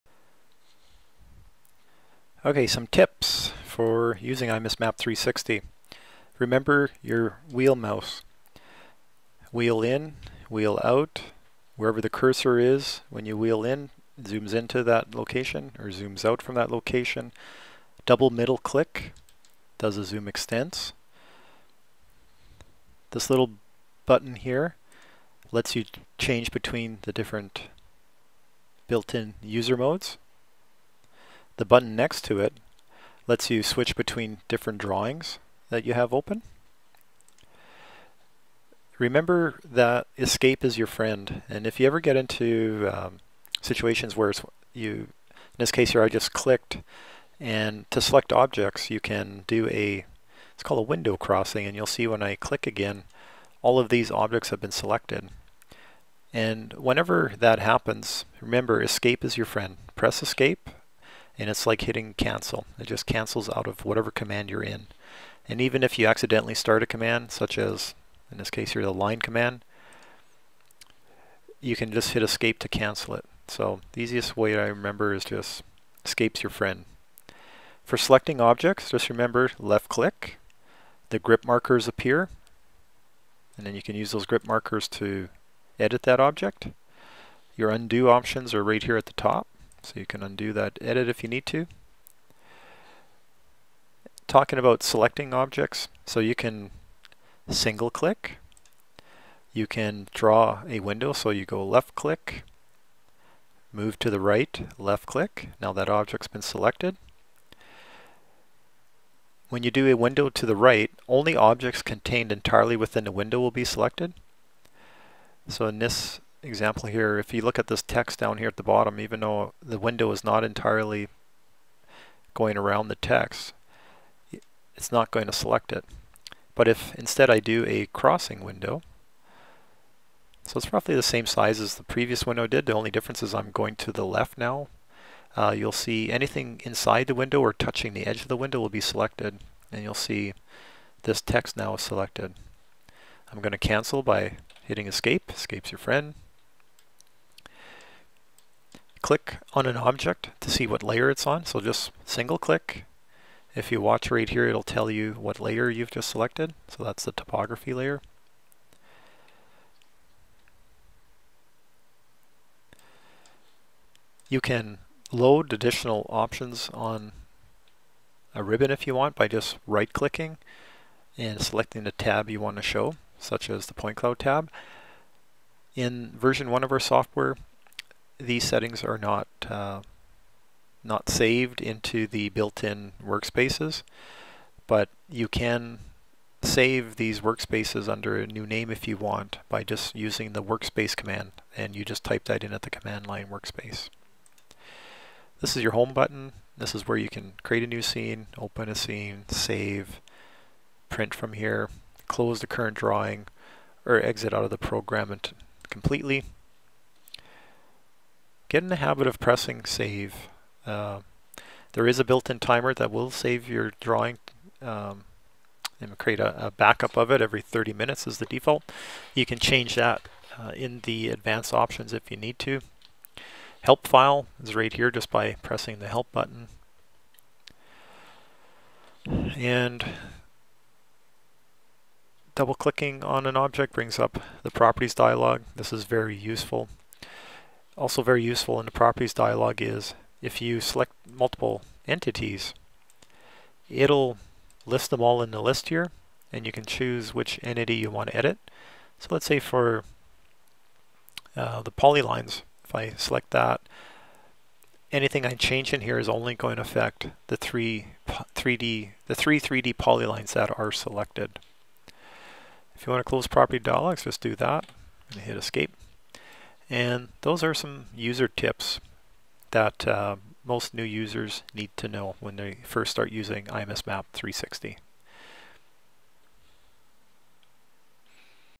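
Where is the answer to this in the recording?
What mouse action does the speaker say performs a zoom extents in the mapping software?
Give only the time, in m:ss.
0:18.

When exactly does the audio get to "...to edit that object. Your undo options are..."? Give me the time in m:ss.
1:24.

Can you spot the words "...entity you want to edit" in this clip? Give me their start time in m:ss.
4:07.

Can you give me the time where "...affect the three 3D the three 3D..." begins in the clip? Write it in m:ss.
4:16.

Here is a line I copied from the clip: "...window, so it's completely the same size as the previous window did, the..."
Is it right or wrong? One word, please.
wrong.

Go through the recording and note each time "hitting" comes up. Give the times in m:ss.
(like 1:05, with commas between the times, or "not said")
1:01, 2:24.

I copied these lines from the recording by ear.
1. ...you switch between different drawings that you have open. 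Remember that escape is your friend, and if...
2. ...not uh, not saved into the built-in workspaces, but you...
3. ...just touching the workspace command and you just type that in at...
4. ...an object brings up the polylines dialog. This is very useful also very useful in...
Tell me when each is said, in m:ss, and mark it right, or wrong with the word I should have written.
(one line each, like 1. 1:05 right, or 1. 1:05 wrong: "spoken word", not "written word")
1. 0:33 right
2. 2:58 right
3. 3:09 wrong: "using", not "touching"
4. 3:53 wrong: "properties", not "polylines".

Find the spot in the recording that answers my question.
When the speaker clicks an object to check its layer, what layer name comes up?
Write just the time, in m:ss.
2:37.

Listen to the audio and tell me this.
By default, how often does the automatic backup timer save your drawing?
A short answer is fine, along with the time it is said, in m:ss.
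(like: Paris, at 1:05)
every 30 minutes, at 3:37.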